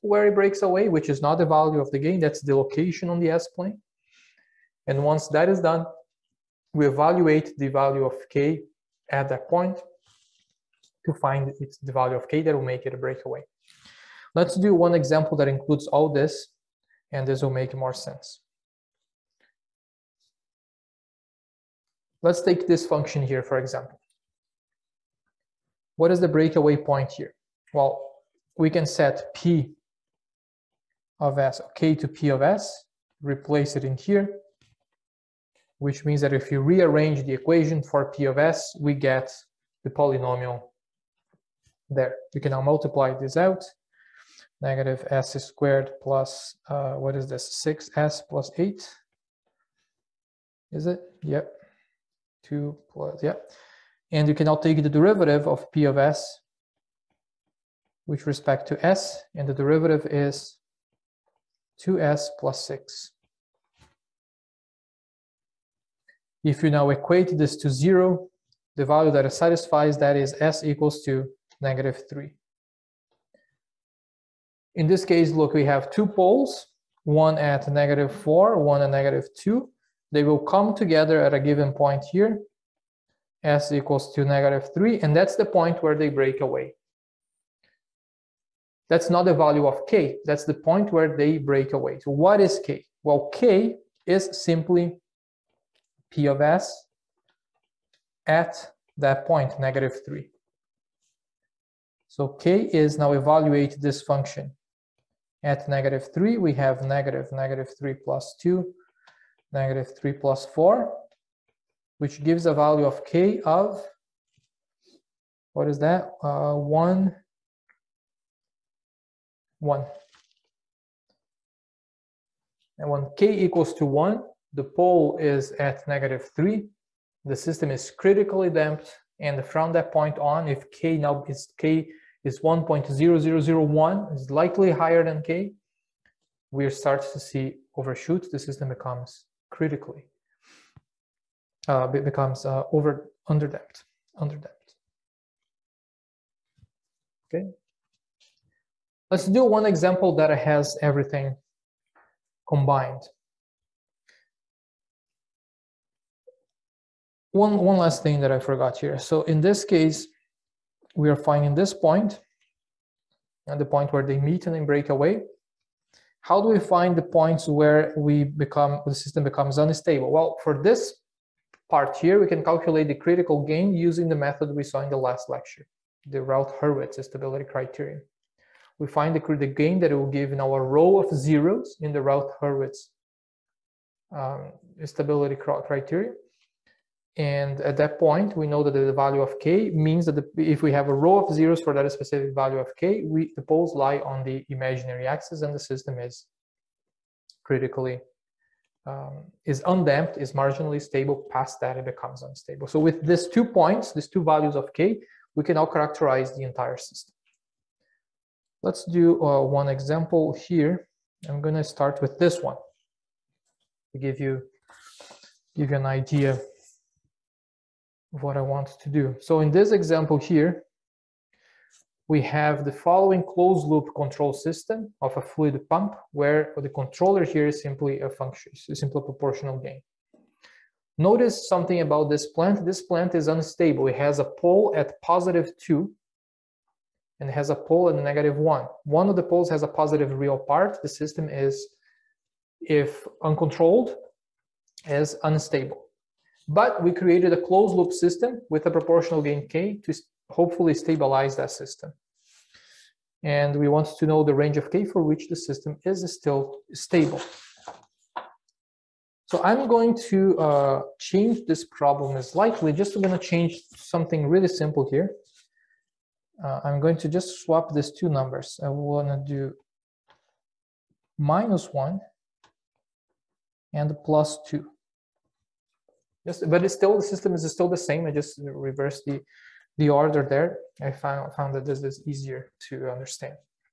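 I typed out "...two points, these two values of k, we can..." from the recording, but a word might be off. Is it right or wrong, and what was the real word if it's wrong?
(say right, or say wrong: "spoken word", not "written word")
right.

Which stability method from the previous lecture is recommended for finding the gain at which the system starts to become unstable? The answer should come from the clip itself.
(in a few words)
Routh Hurwitz stability criterion.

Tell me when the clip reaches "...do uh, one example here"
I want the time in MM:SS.
03:28.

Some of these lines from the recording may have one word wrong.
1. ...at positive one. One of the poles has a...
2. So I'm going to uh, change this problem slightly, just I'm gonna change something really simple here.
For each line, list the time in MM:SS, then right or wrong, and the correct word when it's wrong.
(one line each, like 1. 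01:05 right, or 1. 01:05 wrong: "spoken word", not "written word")
1. 03:57 wrong: "negative", not "positive"
2. 04:19 right.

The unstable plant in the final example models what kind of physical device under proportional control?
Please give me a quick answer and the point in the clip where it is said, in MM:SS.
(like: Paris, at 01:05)
a fluid pump, at 03:45.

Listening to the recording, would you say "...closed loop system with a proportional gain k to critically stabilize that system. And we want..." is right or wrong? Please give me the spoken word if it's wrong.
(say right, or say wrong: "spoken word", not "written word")
wrong: "hopefully", not "critically".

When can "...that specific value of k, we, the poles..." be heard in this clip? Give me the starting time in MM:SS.
03:11.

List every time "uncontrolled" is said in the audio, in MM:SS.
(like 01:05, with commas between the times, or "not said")
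04:03.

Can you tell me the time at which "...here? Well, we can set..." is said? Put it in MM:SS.
00:27.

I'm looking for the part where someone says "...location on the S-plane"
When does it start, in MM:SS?
00:02.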